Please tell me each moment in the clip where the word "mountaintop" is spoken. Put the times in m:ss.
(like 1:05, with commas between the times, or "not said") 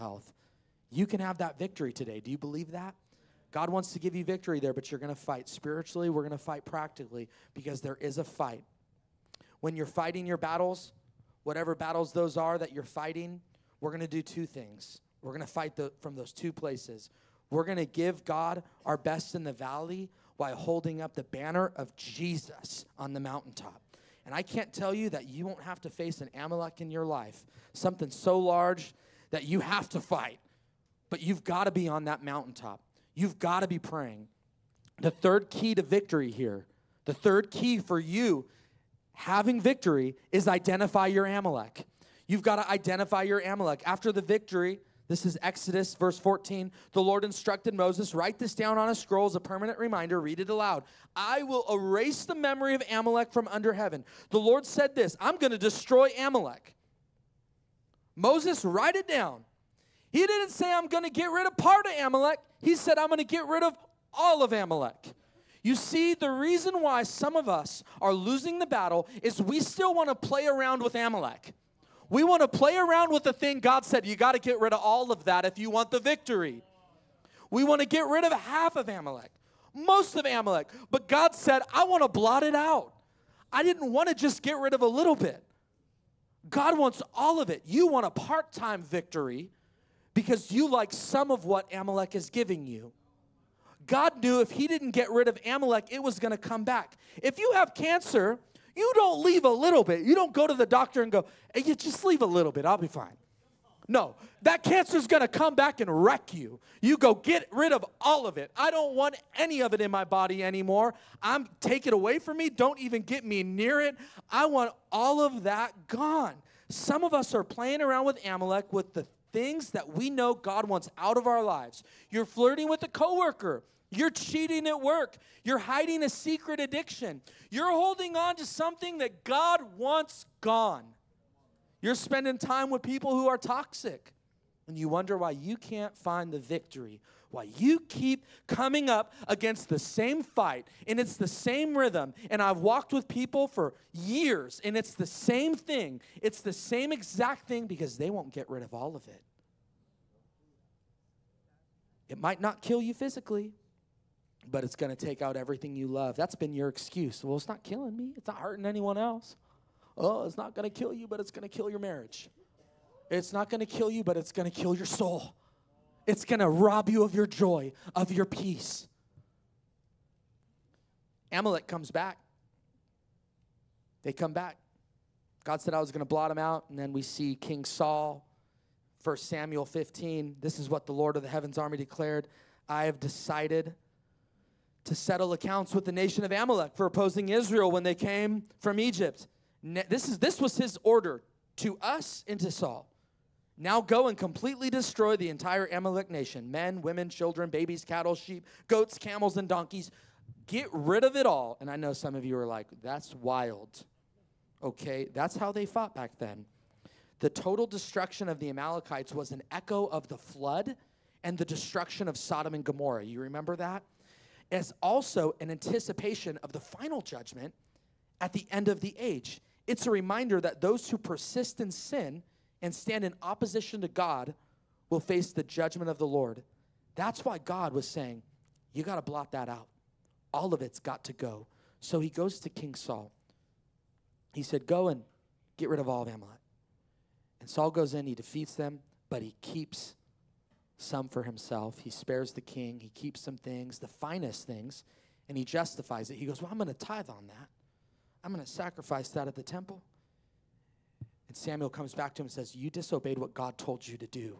0:23, 0:32.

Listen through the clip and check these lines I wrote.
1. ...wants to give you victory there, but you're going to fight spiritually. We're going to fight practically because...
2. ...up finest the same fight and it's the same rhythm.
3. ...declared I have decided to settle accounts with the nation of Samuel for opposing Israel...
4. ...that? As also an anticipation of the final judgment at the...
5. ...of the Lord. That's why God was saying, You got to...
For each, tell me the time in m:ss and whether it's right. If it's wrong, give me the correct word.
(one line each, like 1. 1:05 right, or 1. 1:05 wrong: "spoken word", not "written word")
1. 0:03 right
2. 2:18 wrong: "against", not "finest"
3. 3:01 wrong: "Amalek", not "Samuel"
4. 3:33 right
5. 3:45 right.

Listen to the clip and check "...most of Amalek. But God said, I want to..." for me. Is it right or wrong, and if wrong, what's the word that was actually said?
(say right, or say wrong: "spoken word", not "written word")
right.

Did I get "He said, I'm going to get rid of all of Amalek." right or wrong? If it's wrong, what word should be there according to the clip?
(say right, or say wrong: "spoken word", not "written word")
right.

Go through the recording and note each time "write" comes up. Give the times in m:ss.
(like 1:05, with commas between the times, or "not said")
0:48, 0:58.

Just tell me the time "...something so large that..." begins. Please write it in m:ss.
0:27.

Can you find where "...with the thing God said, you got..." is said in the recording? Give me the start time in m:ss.
1:13.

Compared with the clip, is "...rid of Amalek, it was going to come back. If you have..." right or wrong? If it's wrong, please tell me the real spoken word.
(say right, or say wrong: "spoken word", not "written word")
right.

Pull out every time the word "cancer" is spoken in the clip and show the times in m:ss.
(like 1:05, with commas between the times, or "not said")
1:37, 1:44.